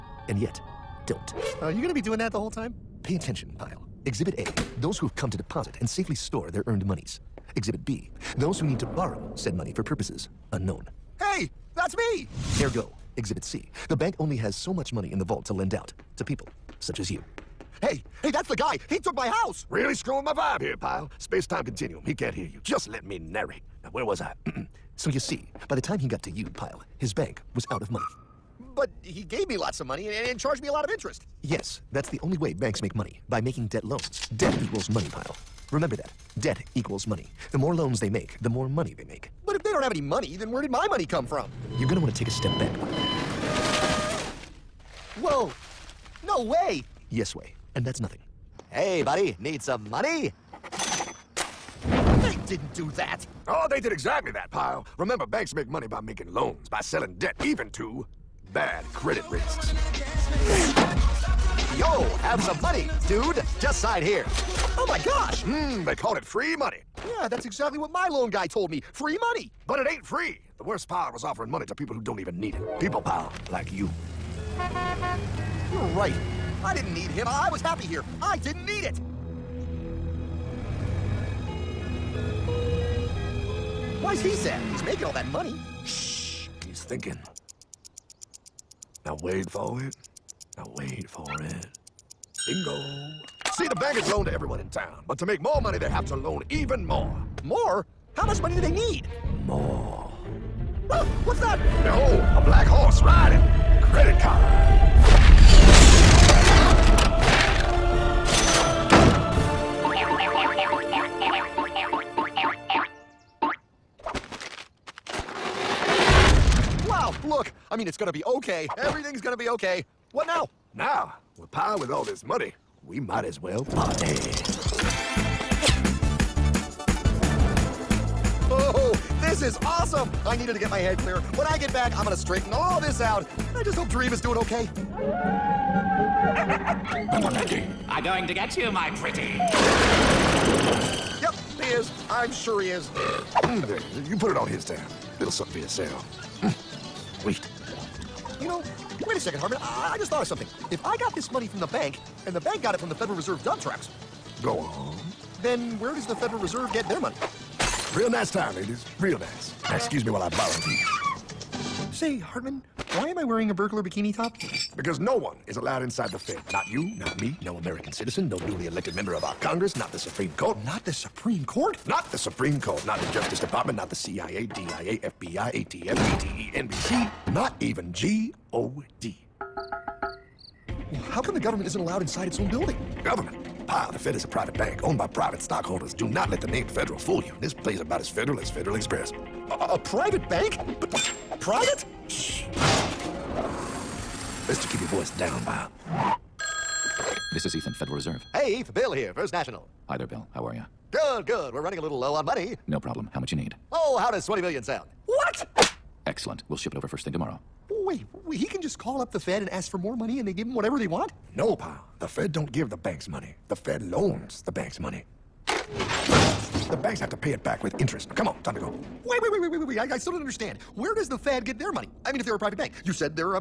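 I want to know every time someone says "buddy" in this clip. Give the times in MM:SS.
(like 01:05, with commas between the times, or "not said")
00:42, 00:49.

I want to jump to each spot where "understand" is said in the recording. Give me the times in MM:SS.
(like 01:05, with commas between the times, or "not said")
03:40.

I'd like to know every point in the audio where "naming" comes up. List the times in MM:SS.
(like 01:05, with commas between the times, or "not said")
not said.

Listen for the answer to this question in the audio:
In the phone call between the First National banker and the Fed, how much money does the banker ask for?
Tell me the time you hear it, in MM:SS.
03:24.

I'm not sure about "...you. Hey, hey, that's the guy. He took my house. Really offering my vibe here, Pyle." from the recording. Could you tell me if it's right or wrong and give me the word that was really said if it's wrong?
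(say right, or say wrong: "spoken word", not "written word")
wrong: "screwing", not "offering".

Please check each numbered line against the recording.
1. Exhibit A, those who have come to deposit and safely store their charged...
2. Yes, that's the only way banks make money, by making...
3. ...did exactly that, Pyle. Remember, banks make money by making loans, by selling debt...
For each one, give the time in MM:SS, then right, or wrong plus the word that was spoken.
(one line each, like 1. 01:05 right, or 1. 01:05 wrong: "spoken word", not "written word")
1. 00:04 wrong: "earned", not "charged"
2. 00:31 right
3. 00:53 right.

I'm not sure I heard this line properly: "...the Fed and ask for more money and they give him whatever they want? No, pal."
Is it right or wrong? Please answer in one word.
right.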